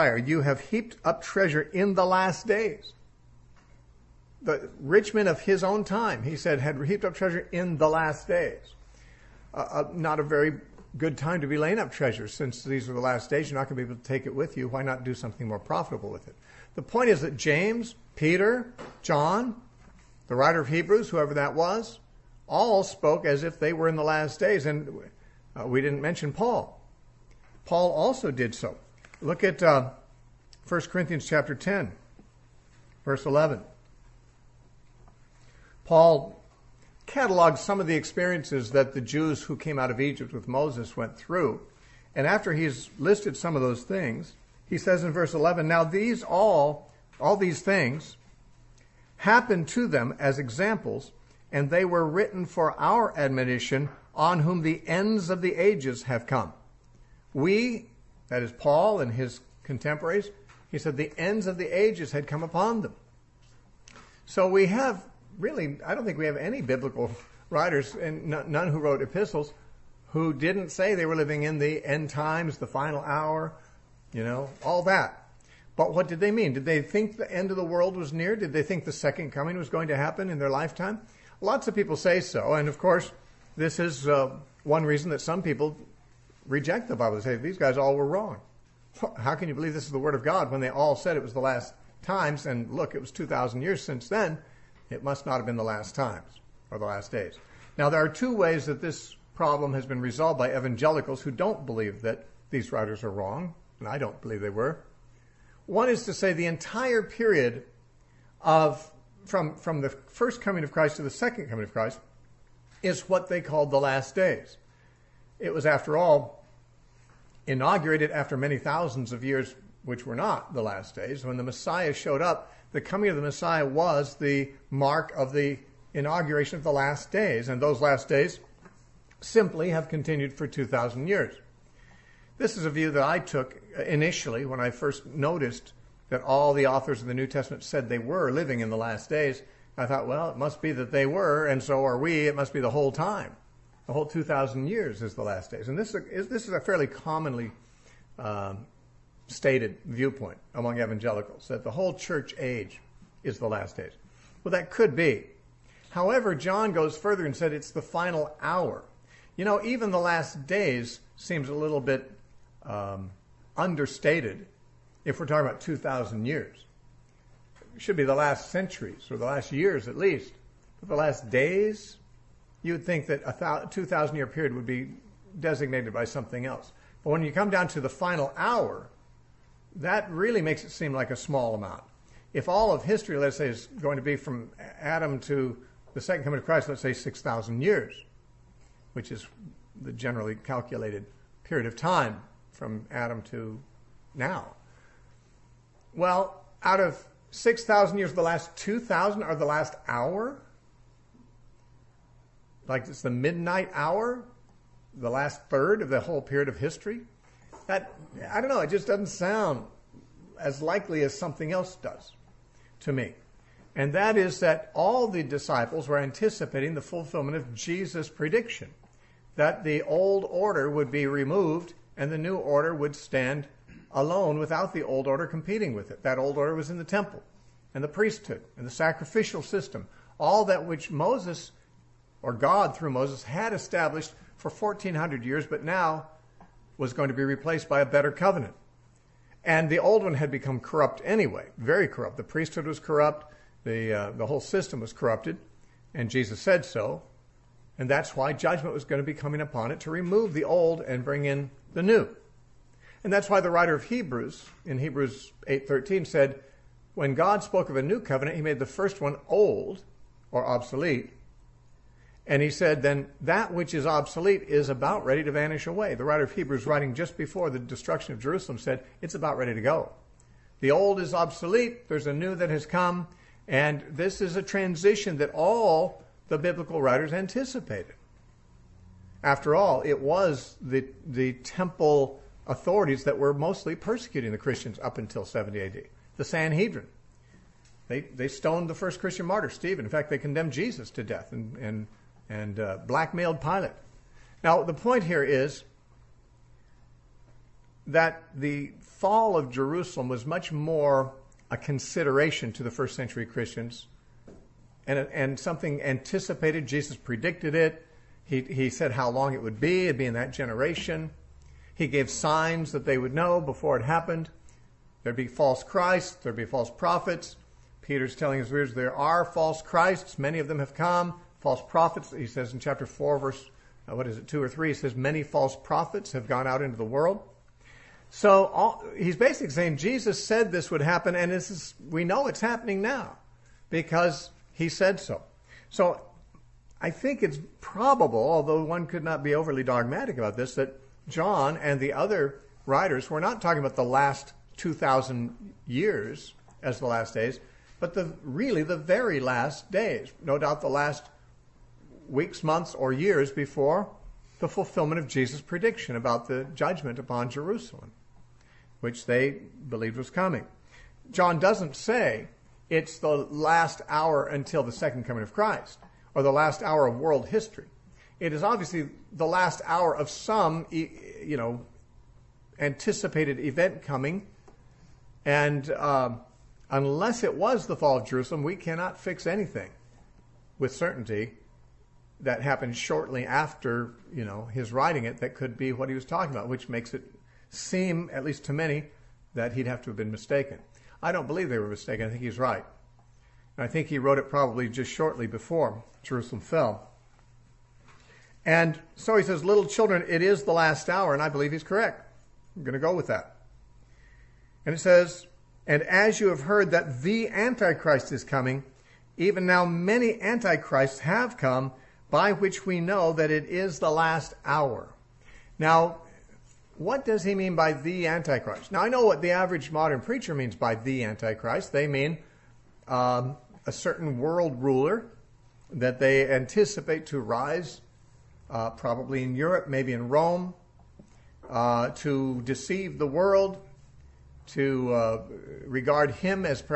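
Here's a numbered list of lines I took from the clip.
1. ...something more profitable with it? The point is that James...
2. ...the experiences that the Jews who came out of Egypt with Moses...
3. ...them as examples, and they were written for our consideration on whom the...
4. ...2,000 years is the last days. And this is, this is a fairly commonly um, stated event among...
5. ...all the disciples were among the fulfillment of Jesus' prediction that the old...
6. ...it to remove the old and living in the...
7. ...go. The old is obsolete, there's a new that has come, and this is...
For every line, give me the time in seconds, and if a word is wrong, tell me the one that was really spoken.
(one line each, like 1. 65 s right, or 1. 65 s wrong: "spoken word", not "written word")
1. 15 s right
2. 37 s right
3. 49 s wrong: "admonition", not "consideration"
4. 144 s wrong: "viewpoint", not "event"
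5. 214 s wrong: "anticipating", not "among"
6. 249 s wrong: "bring", not "living"
7. 269 s right.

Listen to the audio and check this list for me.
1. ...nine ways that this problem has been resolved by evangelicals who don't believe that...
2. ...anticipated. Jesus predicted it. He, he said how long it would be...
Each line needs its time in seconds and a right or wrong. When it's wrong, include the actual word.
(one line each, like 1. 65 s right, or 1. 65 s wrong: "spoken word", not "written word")
1. 98 s wrong: "two", not "nine"
2. 305 s right.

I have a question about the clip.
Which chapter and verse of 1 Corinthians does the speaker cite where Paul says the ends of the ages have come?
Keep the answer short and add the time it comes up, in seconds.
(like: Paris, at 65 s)
Chapter 10, verse 11, at 31 s.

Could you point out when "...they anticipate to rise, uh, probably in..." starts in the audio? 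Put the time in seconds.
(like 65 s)
425 s.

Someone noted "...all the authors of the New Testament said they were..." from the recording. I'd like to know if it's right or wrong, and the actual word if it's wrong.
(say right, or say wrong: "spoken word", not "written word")
right.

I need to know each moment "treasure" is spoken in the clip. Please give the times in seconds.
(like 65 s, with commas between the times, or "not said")
1 s, 7 s, 11 s.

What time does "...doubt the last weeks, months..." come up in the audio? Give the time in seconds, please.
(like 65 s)
350 s.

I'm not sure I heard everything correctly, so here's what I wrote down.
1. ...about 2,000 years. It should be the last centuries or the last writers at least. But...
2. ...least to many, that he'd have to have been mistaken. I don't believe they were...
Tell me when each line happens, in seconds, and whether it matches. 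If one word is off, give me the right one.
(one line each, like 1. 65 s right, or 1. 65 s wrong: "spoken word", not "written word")
1. 165 s wrong: "years", not "writers"
2. 388 s right.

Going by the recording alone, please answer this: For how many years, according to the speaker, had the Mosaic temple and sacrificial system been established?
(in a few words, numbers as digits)
1400.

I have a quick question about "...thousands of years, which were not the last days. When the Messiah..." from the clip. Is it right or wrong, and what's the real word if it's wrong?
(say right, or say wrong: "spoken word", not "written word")
right.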